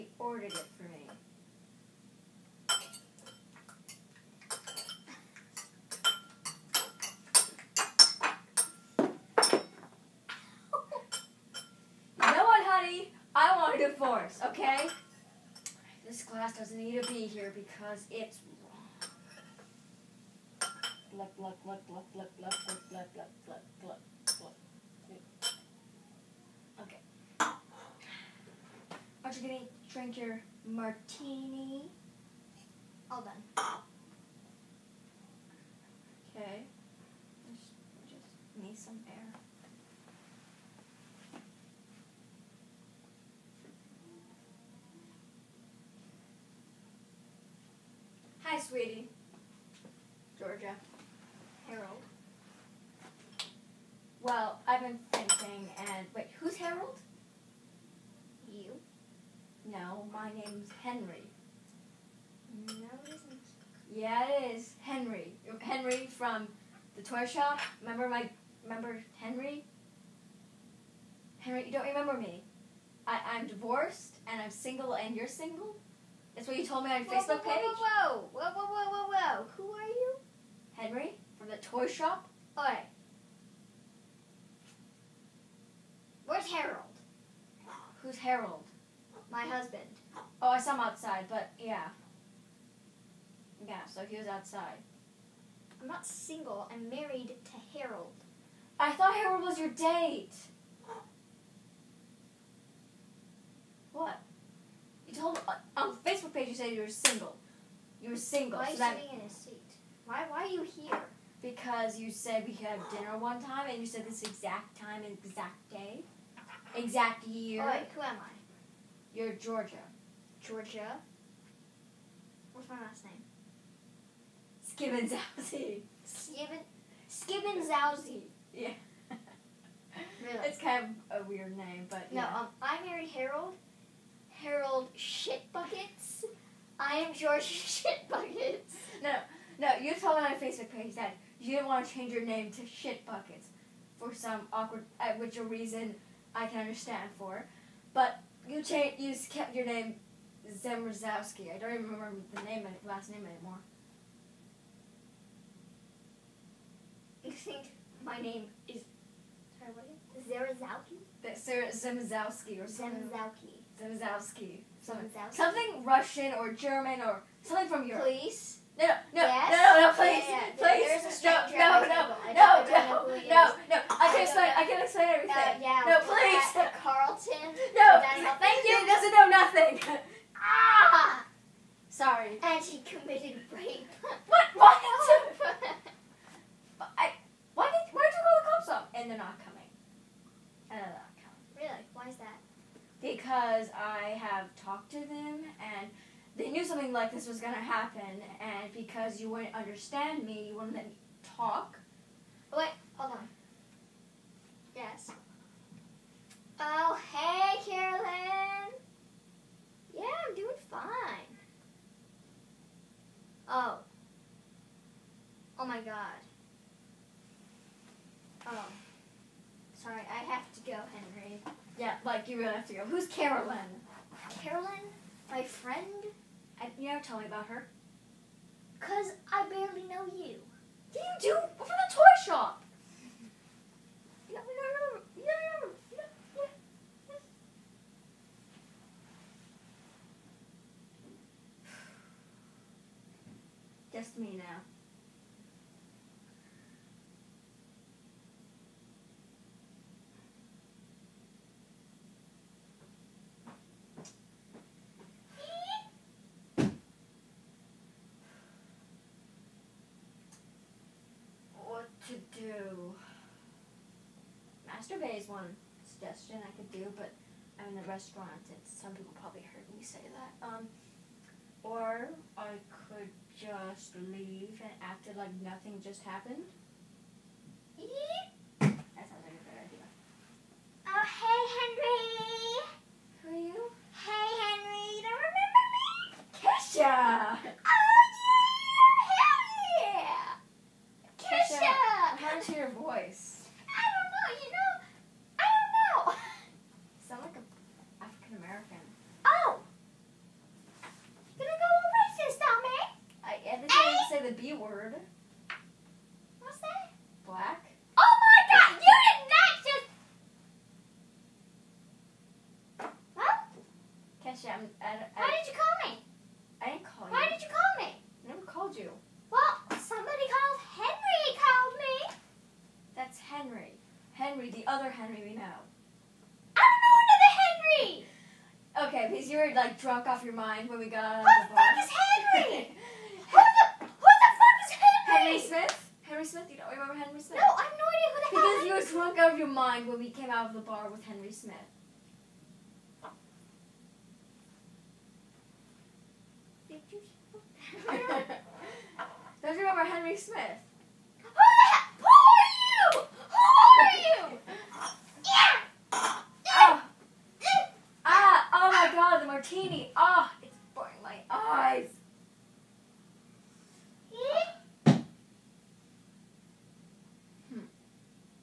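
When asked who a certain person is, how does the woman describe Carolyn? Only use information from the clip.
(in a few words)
my friend.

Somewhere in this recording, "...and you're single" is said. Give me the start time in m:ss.
1:14.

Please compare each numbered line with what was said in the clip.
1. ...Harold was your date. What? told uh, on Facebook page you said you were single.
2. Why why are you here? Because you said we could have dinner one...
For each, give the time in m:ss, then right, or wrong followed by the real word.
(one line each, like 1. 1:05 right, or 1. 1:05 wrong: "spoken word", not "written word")
1. 1:39 right
2. 1:50 right.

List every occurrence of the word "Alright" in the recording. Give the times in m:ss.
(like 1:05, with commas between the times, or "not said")
1:57.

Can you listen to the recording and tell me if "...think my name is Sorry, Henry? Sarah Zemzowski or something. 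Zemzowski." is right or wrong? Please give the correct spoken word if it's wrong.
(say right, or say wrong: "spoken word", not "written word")
wrong: "Zerzowski", not "Henry".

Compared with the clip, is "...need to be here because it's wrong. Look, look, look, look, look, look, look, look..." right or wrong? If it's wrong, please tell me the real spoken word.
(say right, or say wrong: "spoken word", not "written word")
right.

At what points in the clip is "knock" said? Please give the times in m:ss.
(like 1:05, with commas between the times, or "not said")
not said.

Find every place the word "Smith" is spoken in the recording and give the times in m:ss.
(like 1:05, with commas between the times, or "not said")
5:41, 5:50.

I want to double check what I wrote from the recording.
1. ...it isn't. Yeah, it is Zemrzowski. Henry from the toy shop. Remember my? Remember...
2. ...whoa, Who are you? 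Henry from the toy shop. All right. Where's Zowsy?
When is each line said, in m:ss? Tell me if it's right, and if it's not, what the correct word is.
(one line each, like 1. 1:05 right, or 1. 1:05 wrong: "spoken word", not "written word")
1. 1:03 wrong: "Henry", not "Zemrzowski"
2. 1:19 wrong: "Harold", not "Zowsy".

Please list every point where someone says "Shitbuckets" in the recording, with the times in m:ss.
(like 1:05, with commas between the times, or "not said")
2:17, 2:22.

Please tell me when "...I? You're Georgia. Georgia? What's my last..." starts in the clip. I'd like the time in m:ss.
1:58.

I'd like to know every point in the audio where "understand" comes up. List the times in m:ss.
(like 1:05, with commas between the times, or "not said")
2:26, 3:19.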